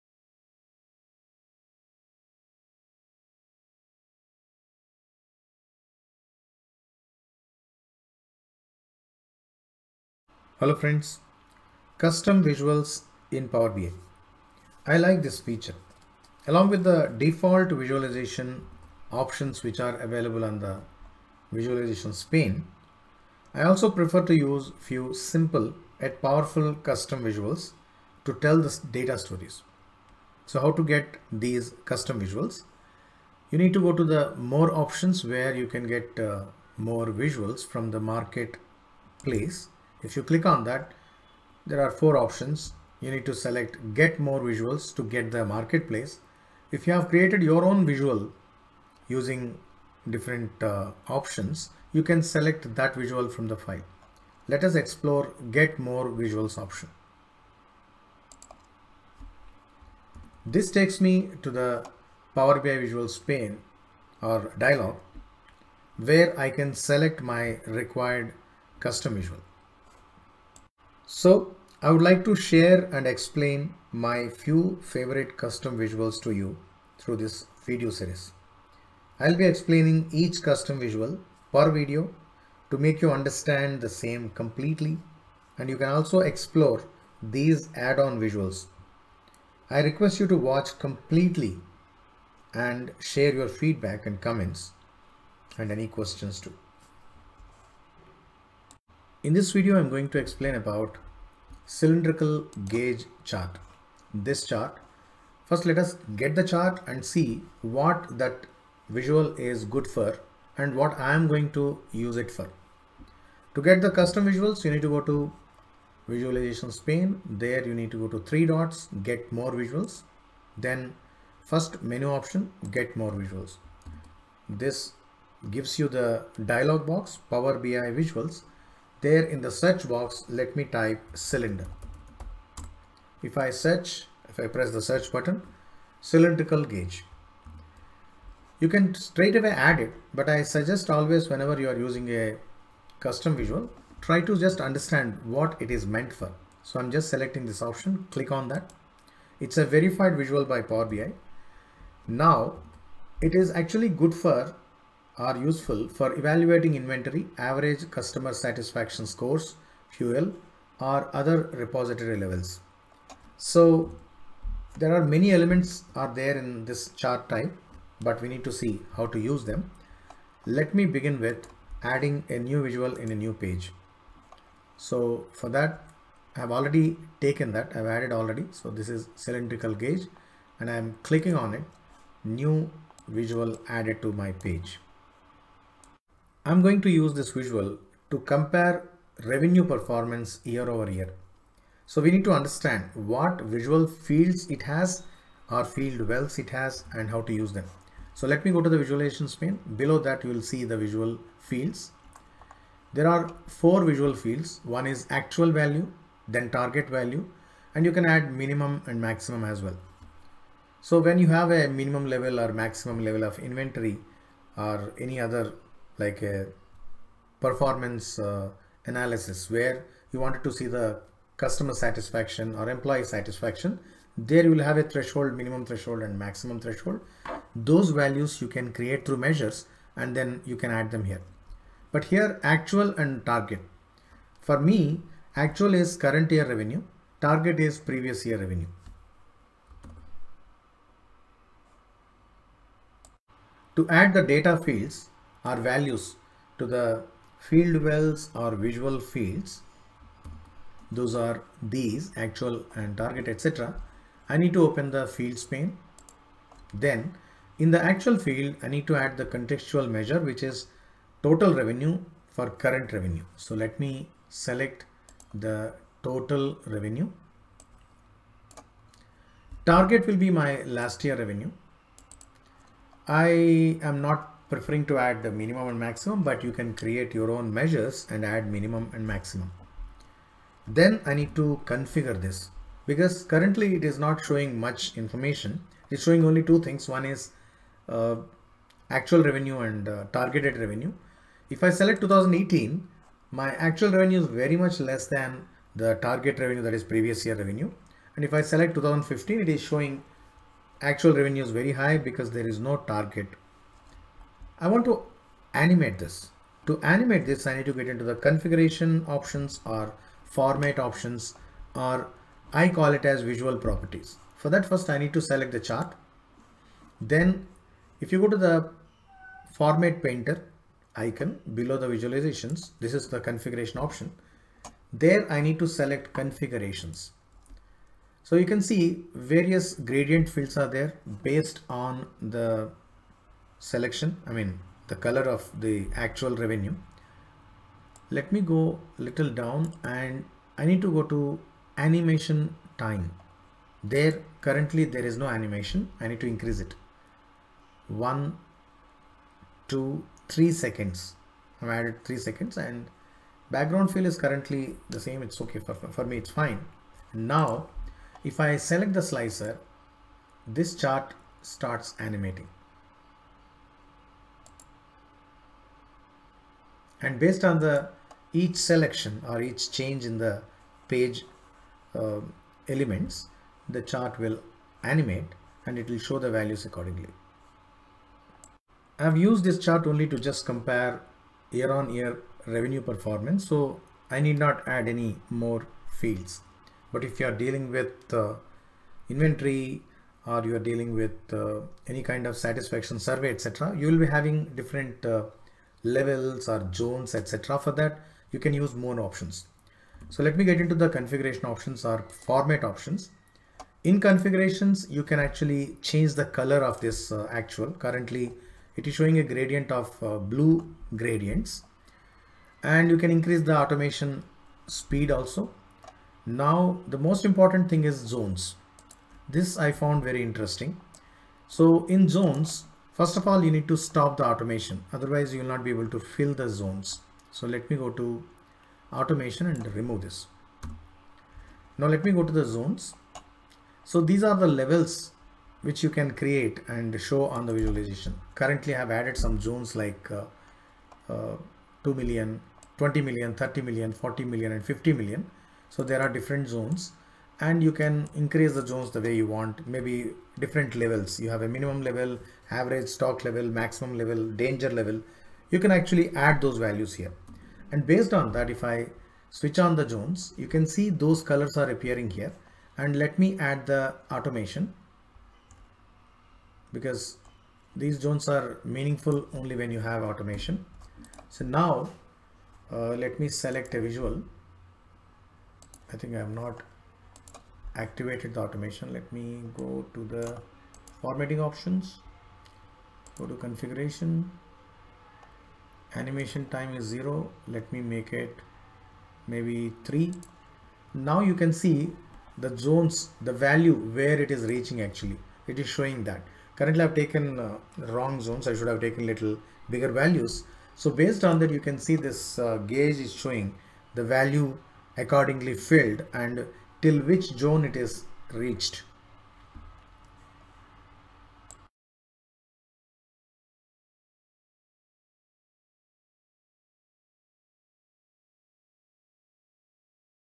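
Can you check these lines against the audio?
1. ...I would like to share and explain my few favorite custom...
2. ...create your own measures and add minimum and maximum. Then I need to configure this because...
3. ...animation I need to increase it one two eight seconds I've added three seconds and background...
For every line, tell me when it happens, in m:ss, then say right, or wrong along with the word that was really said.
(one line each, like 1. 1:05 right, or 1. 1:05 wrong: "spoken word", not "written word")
1. 1:11 right
2. 4:36 right
3. 5:45 wrong: "three", not "eight".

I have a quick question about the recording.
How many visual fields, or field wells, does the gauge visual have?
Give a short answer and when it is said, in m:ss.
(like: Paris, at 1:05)
4, at 3:23.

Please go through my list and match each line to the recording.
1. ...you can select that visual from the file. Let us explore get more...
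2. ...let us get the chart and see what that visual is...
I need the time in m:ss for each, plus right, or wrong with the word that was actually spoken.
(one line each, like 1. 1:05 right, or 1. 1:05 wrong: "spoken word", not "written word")
1. 0:51 right
2. 1:45 right.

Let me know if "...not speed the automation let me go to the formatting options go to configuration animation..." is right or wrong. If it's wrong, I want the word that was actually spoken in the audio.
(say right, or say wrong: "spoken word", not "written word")
wrong: "activated", not "speed".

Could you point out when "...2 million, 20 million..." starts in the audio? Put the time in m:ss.
7:21.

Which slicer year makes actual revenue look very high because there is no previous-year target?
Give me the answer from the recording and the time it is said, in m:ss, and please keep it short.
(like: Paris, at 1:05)
2015, at 4:58.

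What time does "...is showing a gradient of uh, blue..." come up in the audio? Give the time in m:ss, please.
6:48.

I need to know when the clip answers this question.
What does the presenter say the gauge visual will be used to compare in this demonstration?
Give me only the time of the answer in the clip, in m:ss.
3:09.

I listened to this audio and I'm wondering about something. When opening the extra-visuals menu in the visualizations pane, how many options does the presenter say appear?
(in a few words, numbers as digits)
4.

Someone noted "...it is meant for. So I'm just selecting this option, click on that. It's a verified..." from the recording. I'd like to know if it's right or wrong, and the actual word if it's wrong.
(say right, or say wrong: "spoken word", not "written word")
right.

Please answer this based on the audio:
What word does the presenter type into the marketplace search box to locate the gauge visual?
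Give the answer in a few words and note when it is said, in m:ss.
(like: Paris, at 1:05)
cylinder, at 2:11.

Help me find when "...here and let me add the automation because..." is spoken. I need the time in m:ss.
7:42.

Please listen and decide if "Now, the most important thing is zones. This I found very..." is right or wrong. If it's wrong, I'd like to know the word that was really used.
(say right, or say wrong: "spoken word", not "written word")
right.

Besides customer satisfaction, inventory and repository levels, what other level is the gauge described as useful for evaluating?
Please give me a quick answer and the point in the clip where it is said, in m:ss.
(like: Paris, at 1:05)
fuel, at 2:39.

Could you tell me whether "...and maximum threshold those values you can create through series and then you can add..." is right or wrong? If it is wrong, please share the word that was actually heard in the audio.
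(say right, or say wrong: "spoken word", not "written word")
wrong: "measures", not "series".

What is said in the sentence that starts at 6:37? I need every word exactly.
For that, you can use more options.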